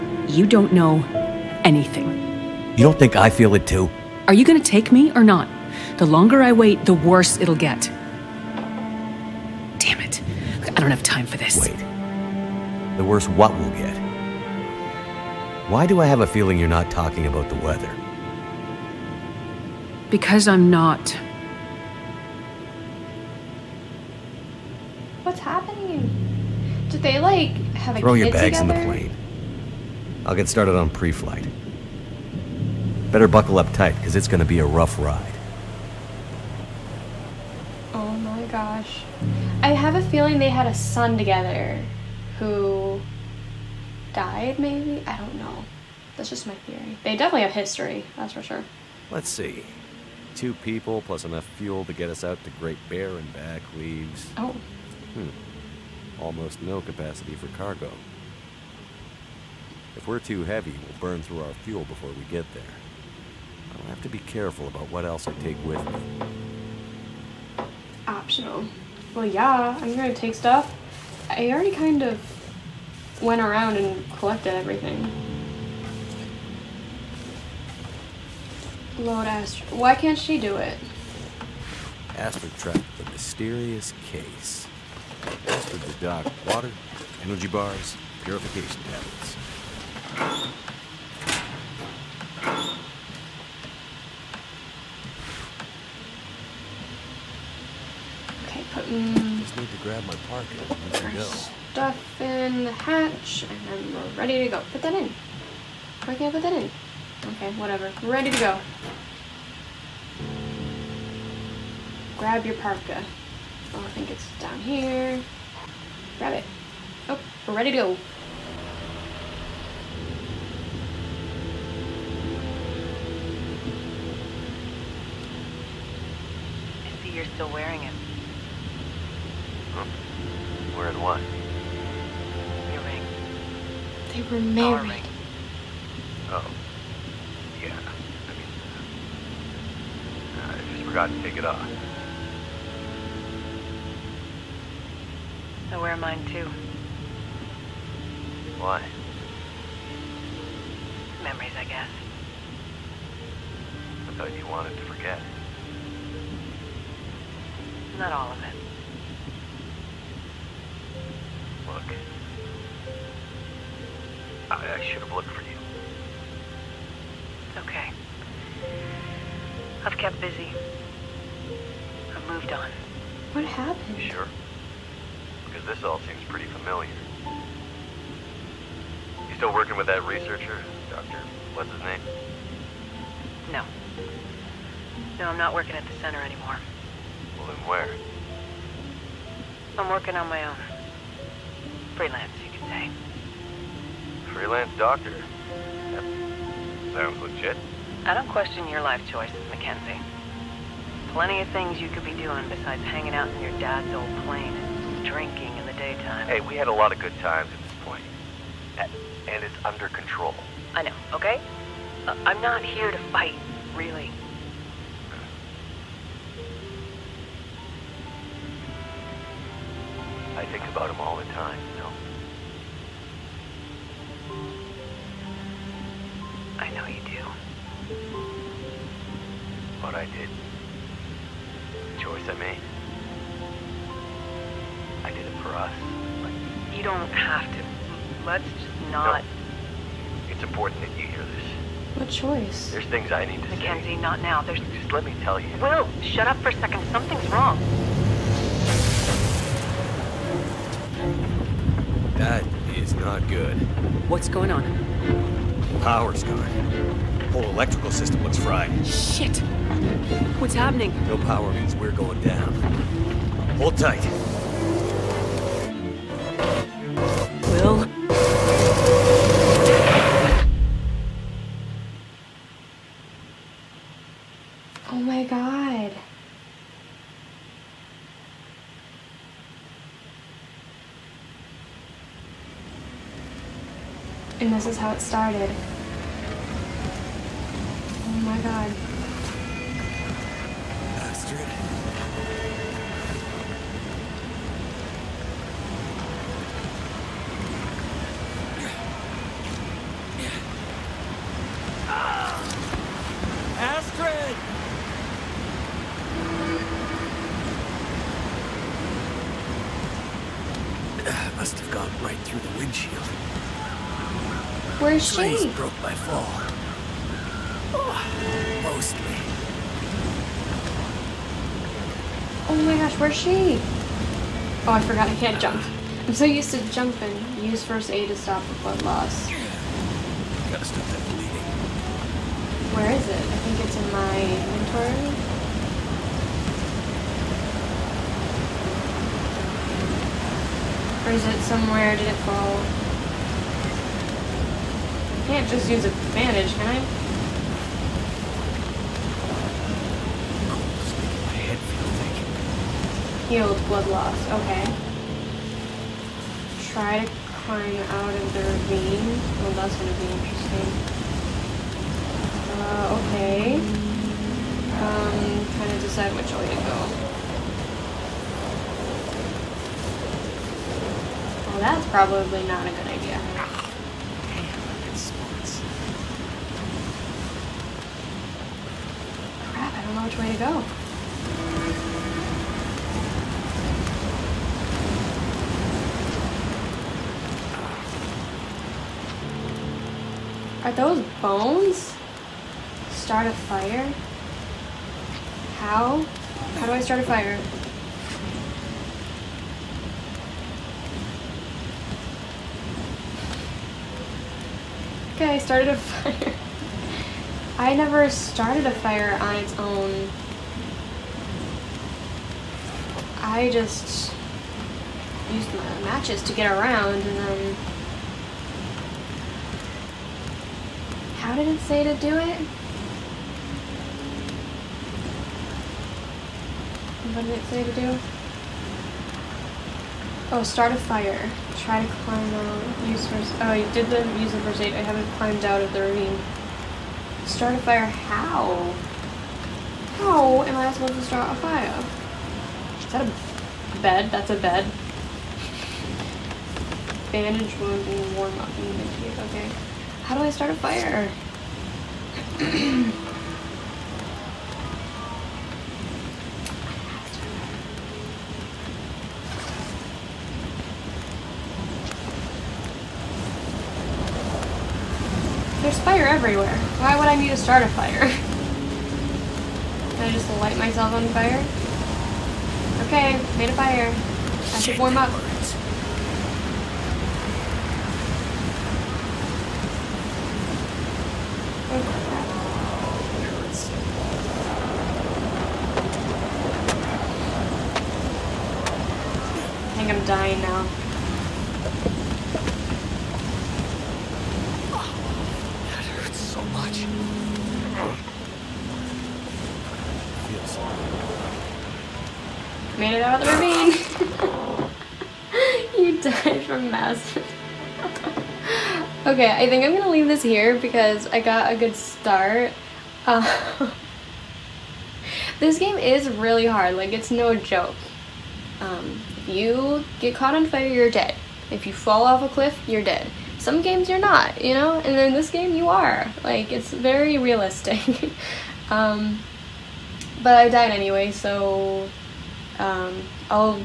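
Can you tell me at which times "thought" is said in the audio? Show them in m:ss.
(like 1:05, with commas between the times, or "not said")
2:34.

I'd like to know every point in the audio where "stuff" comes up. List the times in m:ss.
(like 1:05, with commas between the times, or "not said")
1:10, 1:41.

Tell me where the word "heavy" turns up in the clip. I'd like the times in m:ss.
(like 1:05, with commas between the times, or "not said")
1:00.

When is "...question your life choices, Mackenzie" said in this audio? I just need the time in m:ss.
3:18.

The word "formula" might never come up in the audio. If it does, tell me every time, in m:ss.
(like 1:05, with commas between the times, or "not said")
not said.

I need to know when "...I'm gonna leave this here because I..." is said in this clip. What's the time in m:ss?
8:29.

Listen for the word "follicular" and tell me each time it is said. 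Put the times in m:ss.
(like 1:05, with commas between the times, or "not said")
not said.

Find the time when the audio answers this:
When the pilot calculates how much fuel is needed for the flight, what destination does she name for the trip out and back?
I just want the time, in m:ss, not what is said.
0:52.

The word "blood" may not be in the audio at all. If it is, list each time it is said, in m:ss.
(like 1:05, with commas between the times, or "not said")
5:28, 5:53.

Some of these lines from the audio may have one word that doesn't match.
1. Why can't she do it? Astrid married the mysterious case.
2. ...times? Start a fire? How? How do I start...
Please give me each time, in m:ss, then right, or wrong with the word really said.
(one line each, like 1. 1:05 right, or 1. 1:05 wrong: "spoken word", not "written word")
1. 1:19 wrong: "tracked", not "married"
2. 6:31 wrong: "bones", not "times".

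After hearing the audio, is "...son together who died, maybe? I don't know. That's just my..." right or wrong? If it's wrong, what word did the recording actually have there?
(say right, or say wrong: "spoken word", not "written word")
right.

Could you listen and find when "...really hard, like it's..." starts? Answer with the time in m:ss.
8:36.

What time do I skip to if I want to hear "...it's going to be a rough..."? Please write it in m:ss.
0:34.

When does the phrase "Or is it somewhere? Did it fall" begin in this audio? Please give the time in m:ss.
5:41.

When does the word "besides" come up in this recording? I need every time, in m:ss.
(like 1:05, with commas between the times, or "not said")
3:22.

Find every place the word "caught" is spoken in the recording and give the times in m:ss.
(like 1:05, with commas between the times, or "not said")
8:40.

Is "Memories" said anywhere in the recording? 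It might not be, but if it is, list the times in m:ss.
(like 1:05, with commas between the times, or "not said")
2:31.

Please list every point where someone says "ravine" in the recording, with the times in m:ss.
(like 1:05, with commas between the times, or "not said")
5:58, 7:15, 8:23.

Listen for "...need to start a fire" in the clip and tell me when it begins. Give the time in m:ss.
7:47.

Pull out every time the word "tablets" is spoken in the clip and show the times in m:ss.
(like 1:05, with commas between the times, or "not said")
1:28.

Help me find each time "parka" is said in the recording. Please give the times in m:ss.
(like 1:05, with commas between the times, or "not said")
1:40, 1:52.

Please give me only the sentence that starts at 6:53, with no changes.
I just used my matches to get around and then...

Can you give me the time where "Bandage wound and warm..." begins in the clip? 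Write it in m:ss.
7:27.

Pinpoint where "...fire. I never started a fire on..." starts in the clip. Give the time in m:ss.
6:45.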